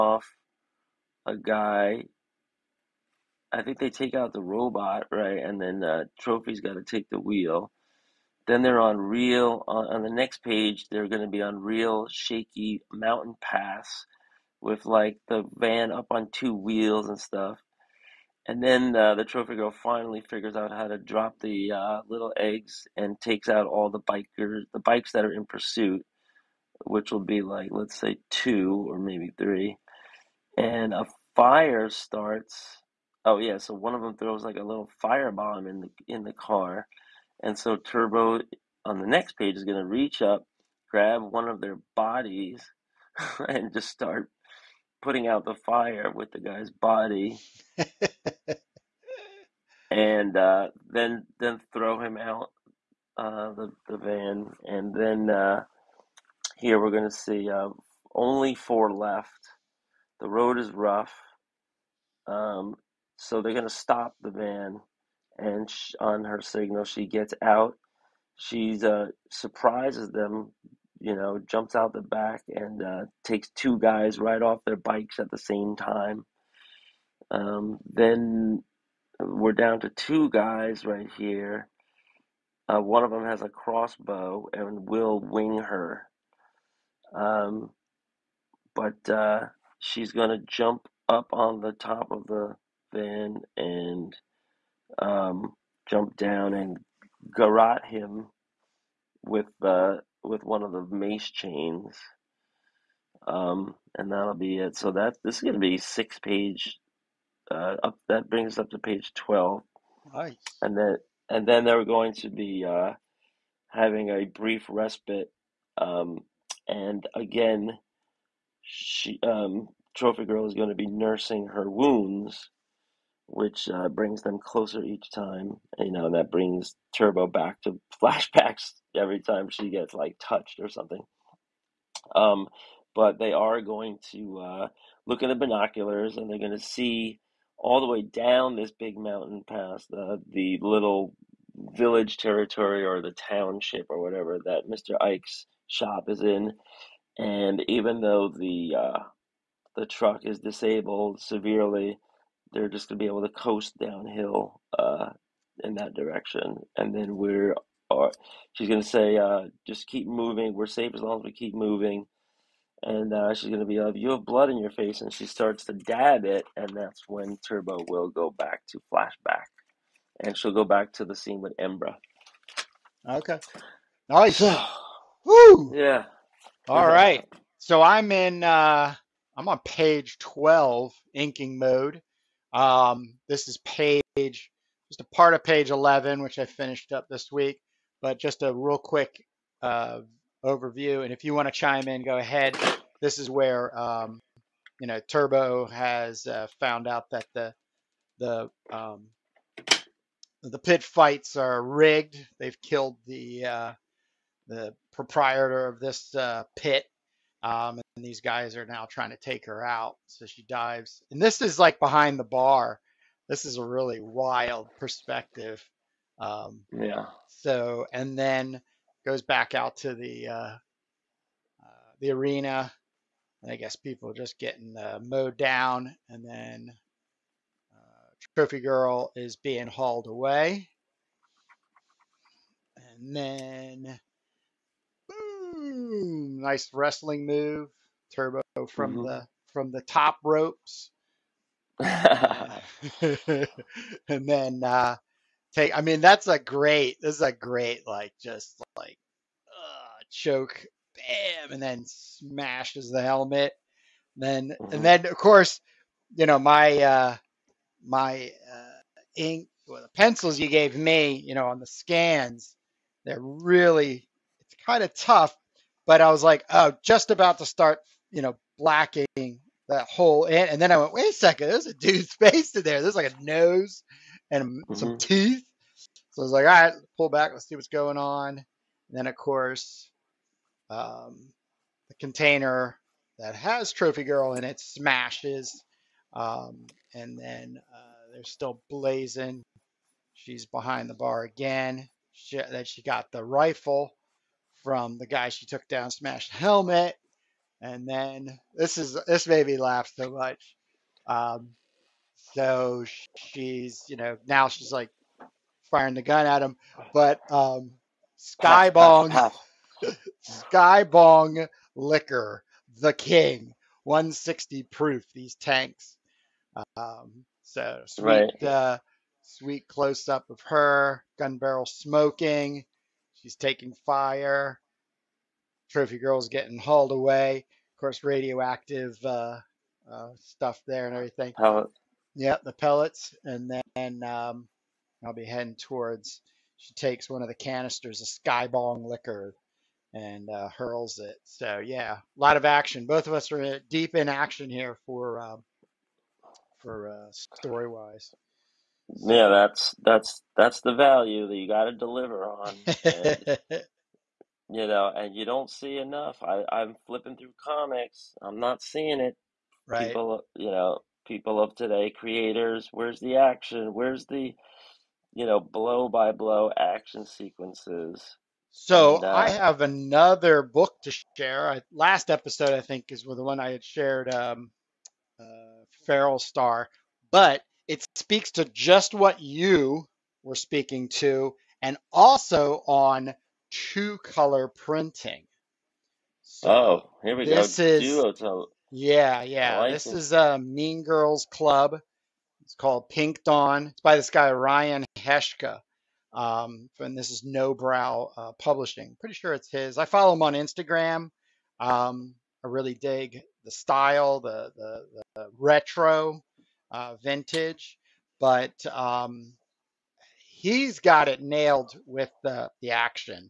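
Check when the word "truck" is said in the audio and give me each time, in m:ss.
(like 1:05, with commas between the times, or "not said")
2:29.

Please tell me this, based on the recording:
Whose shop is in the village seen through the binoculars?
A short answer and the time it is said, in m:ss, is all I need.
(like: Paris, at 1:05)
Mr. Ike, at 2:24.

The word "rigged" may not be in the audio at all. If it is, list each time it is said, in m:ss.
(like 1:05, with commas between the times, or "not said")
3:21.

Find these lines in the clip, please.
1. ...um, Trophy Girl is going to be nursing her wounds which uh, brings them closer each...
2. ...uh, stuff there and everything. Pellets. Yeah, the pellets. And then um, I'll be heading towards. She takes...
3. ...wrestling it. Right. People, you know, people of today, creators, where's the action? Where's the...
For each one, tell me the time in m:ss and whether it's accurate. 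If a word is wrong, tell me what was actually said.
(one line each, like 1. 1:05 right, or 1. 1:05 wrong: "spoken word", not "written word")
1. 1:59 right
2. 5:29 right
3. 5:58 wrong: "seeing", not "wrestling".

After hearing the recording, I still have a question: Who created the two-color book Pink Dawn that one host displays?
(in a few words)
Ryan Heshka.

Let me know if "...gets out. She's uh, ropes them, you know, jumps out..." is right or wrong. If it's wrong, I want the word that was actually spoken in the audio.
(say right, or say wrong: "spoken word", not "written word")
wrong: "surprises", not "ropes".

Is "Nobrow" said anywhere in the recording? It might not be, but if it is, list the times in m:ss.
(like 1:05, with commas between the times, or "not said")
6:37.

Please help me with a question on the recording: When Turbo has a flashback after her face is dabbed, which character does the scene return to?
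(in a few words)
Embra.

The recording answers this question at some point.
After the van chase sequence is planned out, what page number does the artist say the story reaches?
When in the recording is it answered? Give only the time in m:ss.
1:48.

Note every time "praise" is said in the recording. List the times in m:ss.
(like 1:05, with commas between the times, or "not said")
not said.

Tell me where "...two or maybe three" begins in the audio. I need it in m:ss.
0:28.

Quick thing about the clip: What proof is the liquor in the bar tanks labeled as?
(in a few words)
160 proof.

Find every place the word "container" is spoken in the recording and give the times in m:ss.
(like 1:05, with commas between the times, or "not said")
4:41.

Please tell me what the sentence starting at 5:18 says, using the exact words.
uh, sweet close up of her gun barrel smoking.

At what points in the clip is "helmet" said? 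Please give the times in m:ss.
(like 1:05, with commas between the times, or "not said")
4:13, 4:56.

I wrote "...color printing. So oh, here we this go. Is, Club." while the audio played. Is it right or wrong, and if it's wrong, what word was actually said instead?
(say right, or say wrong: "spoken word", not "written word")
wrong: "Duotel", not "Club".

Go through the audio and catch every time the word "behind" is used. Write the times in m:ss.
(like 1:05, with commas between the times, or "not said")
3:31, 4:50.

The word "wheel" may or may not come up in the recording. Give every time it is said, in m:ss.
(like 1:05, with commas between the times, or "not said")
0:07, 0:16.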